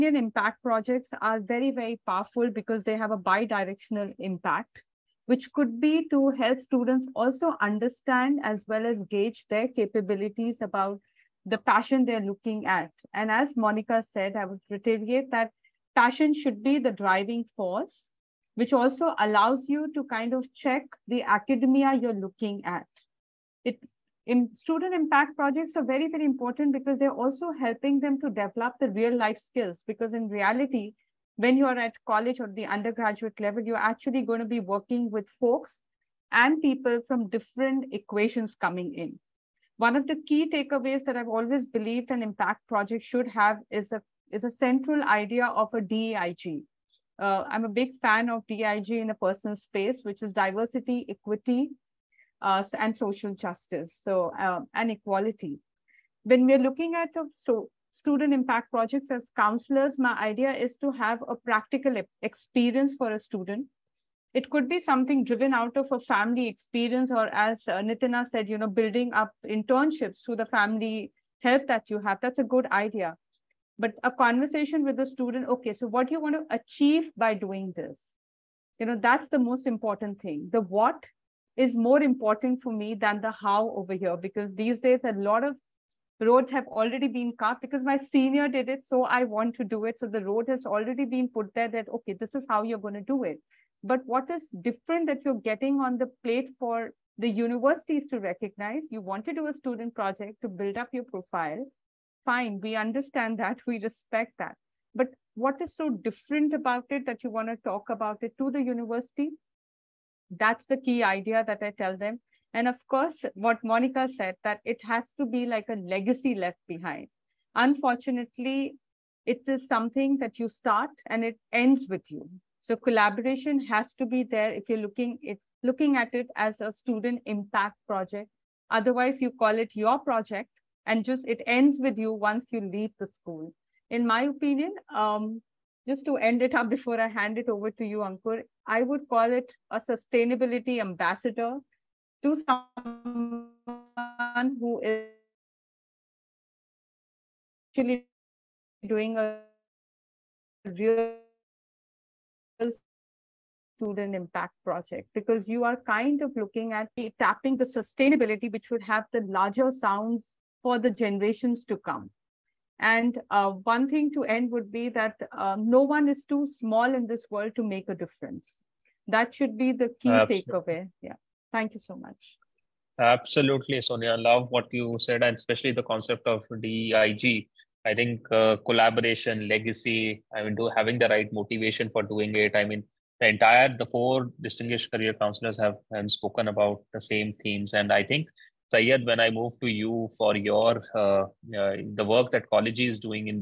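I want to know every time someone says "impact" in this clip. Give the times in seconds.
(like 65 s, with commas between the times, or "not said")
0 s, 4 s, 24 s, 42 s, 58 s, 127 s, 154 s.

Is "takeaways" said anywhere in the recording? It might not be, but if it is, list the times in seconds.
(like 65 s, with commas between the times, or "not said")
40 s, 170 s.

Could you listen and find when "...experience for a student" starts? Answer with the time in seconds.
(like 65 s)
62 s.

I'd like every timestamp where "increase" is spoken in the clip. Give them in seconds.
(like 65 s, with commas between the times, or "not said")
not said.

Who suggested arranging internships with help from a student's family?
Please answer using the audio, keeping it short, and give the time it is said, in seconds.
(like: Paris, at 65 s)
Nitina, at 67 s.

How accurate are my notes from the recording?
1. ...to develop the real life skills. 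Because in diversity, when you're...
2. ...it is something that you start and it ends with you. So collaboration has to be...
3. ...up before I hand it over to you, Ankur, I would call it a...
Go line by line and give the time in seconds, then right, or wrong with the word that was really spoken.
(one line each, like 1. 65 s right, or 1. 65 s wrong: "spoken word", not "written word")
1. 28 s wrong: "reality", not "diversity"
2. 119 s right
3. 136 s right.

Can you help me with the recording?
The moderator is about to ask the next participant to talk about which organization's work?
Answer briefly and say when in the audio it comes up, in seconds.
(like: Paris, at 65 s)
Collegey, at 192 s.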